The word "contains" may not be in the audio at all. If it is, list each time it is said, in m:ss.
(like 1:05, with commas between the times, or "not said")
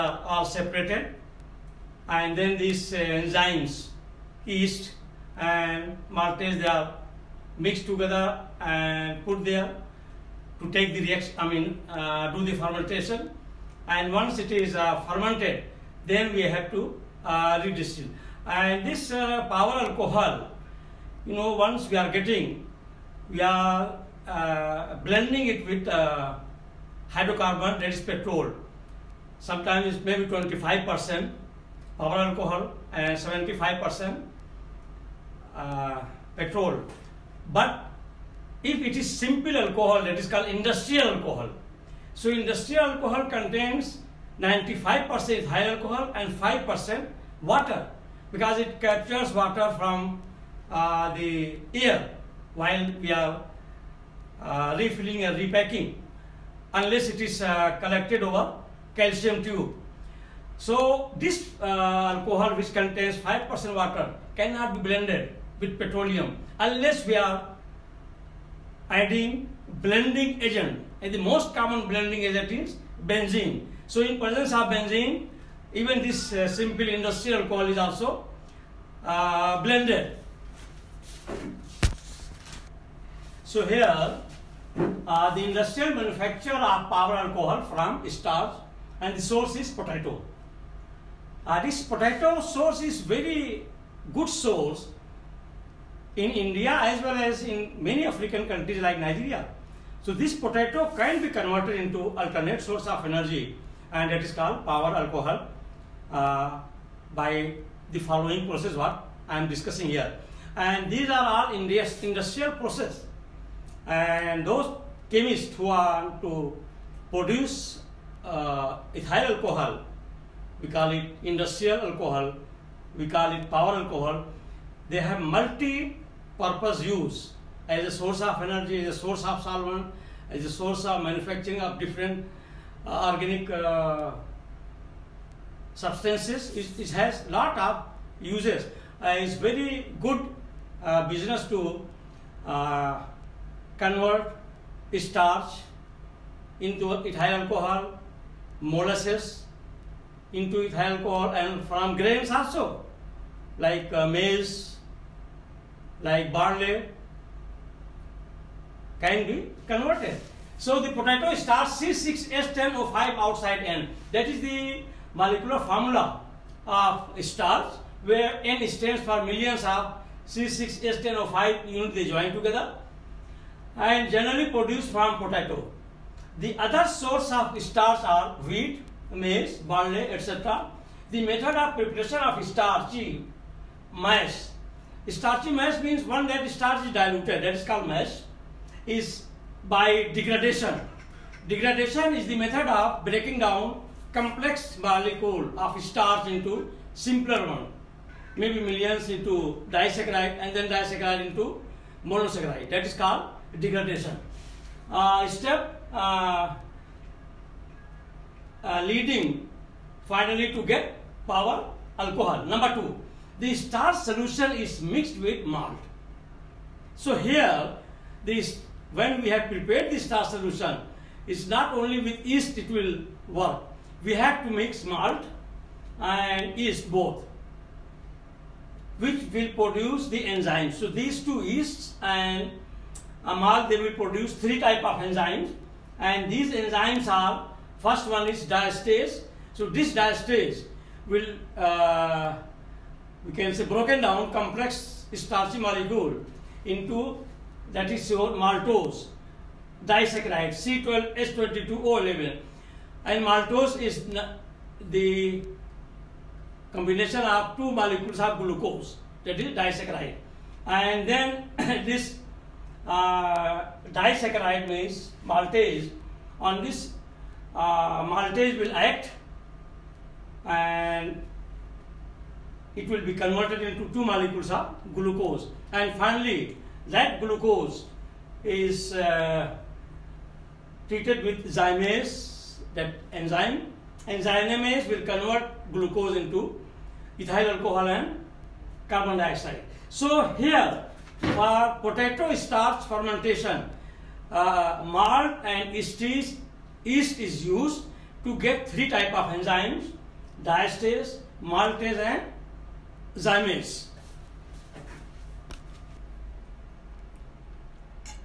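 0:43, 1:02.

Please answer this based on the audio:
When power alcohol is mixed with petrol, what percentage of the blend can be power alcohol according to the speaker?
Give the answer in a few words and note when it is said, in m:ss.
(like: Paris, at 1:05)
25%, at 0:30.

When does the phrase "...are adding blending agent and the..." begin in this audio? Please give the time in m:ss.
1:07.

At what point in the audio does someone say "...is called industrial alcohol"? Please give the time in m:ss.
0:40.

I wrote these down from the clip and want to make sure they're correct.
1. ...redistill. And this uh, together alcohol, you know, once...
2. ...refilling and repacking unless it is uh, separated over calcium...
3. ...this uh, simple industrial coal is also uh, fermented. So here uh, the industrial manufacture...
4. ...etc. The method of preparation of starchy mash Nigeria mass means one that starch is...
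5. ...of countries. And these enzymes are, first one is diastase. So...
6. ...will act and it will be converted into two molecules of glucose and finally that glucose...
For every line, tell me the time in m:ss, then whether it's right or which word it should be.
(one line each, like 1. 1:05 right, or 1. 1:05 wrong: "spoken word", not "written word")
1. 0:17 wrong: "power", not "together"
2. 0:54 wrong: "collected", not "separated"
3. 1:16 wrong: "blended", not "fermented"
4. 3:00 wrong: "Starchy", not "Nigeria"
5. 3:54 wrong: "enzymes", not "countries"
6. 4:28 right.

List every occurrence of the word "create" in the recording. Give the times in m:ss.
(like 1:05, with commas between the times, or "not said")
not said.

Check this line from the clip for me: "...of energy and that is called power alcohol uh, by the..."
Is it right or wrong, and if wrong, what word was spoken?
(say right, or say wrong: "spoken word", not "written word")
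right.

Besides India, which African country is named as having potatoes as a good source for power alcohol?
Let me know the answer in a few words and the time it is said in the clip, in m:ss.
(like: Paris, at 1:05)
Nigeria, at 1:38.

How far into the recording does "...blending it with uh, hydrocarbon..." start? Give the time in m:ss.
0:25.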